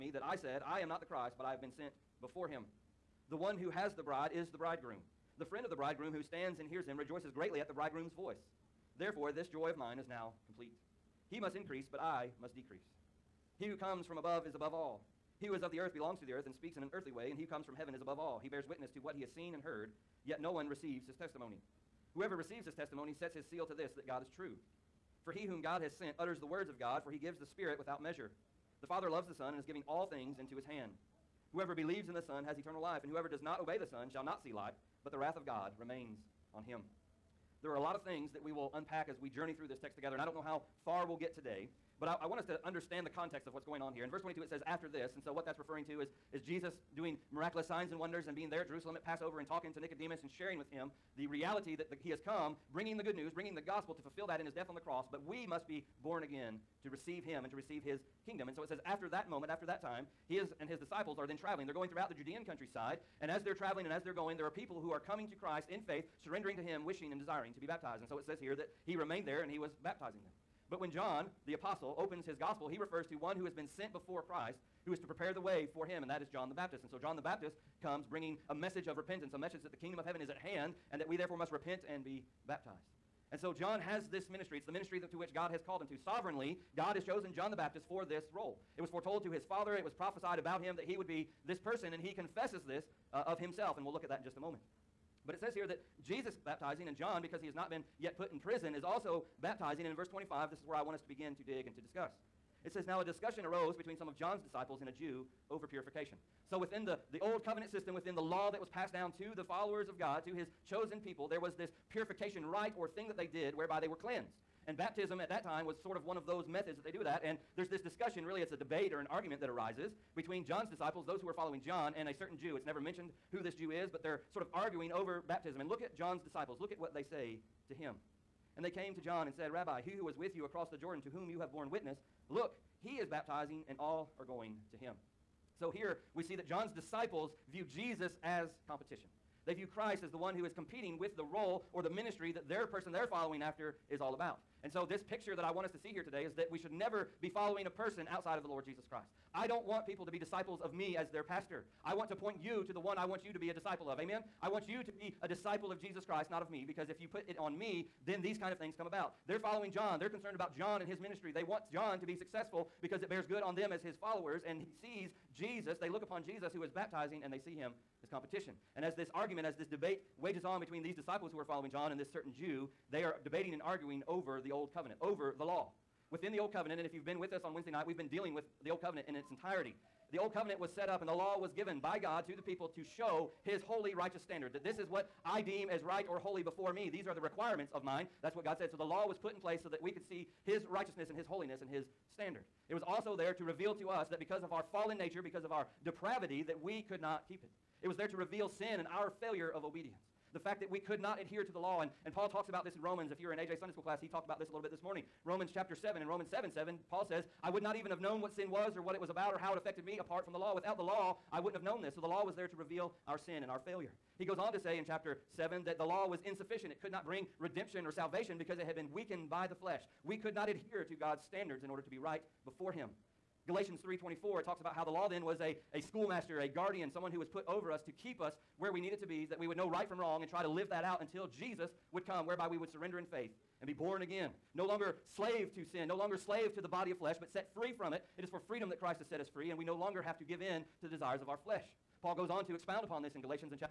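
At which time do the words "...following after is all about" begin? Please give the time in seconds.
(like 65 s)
143 s.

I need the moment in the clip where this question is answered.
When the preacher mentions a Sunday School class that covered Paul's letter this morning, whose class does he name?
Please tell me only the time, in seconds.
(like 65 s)
203 s.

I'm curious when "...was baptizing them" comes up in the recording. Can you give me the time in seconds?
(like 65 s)
69 s.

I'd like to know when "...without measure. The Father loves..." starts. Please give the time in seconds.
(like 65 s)
27 s.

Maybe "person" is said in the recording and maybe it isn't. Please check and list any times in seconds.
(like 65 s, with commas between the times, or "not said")
91 s, 142 s, 147 s.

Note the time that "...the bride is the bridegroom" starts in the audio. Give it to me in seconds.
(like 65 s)
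3 s.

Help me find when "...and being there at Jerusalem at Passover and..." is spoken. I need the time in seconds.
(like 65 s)
48 s.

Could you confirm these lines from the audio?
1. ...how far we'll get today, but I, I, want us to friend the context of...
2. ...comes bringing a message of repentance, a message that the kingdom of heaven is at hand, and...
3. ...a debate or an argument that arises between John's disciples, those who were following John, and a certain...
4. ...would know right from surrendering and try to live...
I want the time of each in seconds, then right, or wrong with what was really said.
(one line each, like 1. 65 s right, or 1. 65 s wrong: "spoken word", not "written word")
1. 40 s wrong: "understand", not "friend"
2. 77 s right
3. 118 s right
4. 229 s wrong: "wrong", not "surrendering".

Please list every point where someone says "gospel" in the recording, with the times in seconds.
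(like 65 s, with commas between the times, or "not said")
53 s, 72 s.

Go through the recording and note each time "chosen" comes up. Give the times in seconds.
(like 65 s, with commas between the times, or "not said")
87 s, 110 s.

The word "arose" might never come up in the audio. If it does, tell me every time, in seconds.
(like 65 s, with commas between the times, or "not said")
103 s.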